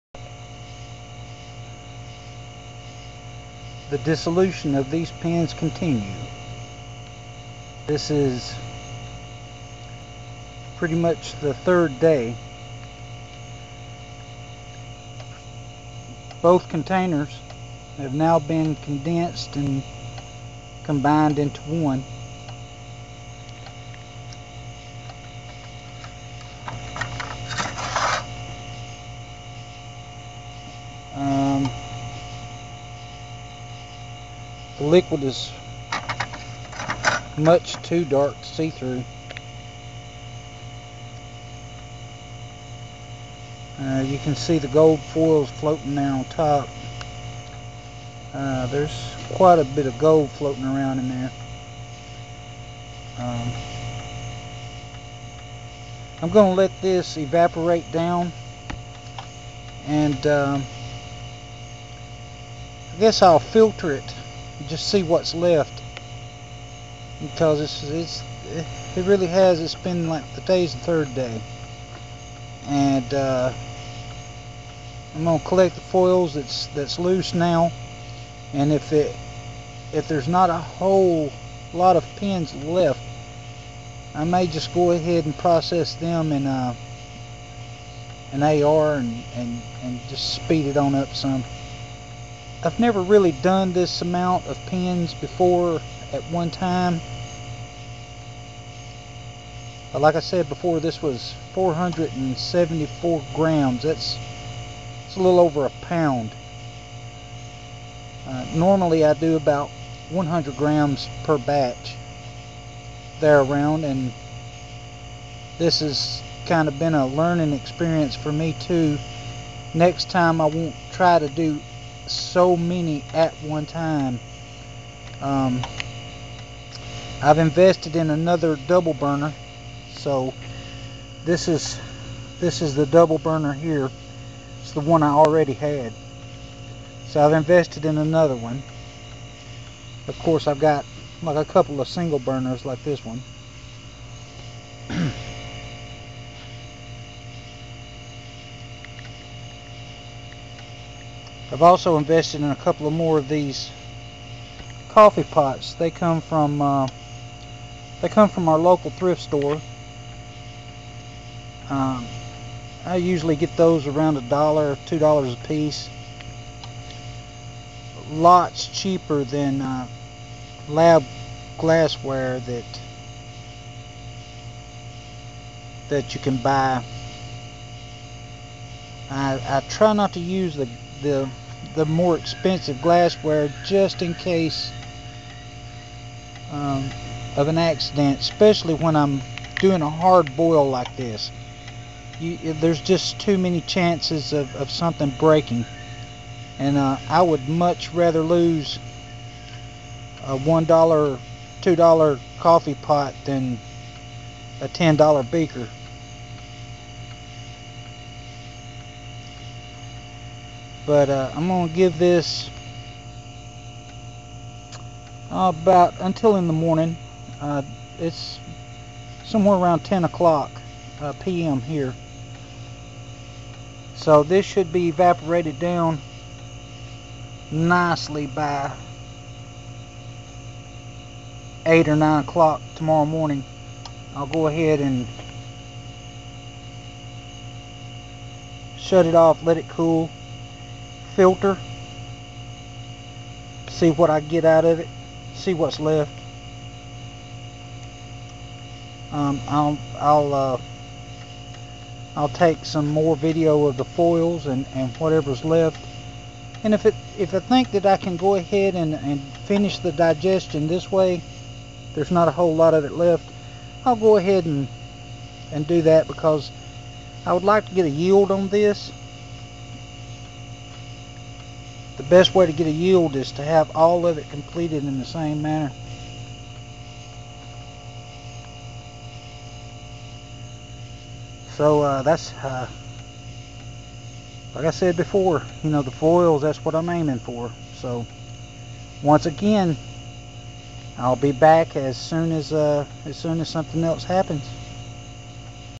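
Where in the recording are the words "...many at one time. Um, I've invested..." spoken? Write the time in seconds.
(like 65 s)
122 s.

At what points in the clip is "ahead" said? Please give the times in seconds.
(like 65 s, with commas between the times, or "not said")
84 s, 234 s, 258 s, 264 s.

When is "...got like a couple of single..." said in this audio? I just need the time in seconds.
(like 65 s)
140 s.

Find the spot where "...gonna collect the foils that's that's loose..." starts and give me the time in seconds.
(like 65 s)
75 s.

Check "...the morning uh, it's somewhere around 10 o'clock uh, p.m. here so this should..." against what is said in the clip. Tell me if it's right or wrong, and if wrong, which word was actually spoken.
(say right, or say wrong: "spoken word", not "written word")
right.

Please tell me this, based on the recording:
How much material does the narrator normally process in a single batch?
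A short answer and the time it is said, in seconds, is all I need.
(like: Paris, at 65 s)
100 grams, at 110 s.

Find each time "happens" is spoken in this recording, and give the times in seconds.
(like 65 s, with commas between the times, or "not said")
294 s.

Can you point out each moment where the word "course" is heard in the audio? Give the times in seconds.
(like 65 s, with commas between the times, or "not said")
140 s.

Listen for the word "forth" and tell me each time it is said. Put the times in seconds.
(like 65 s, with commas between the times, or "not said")
not said.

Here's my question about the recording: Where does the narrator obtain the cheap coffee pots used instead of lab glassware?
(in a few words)
local thrift store.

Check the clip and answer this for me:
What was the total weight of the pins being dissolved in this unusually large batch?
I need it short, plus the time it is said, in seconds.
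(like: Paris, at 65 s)
474 grams, at 101 s.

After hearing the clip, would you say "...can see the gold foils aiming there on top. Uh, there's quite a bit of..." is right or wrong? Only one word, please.
wrong.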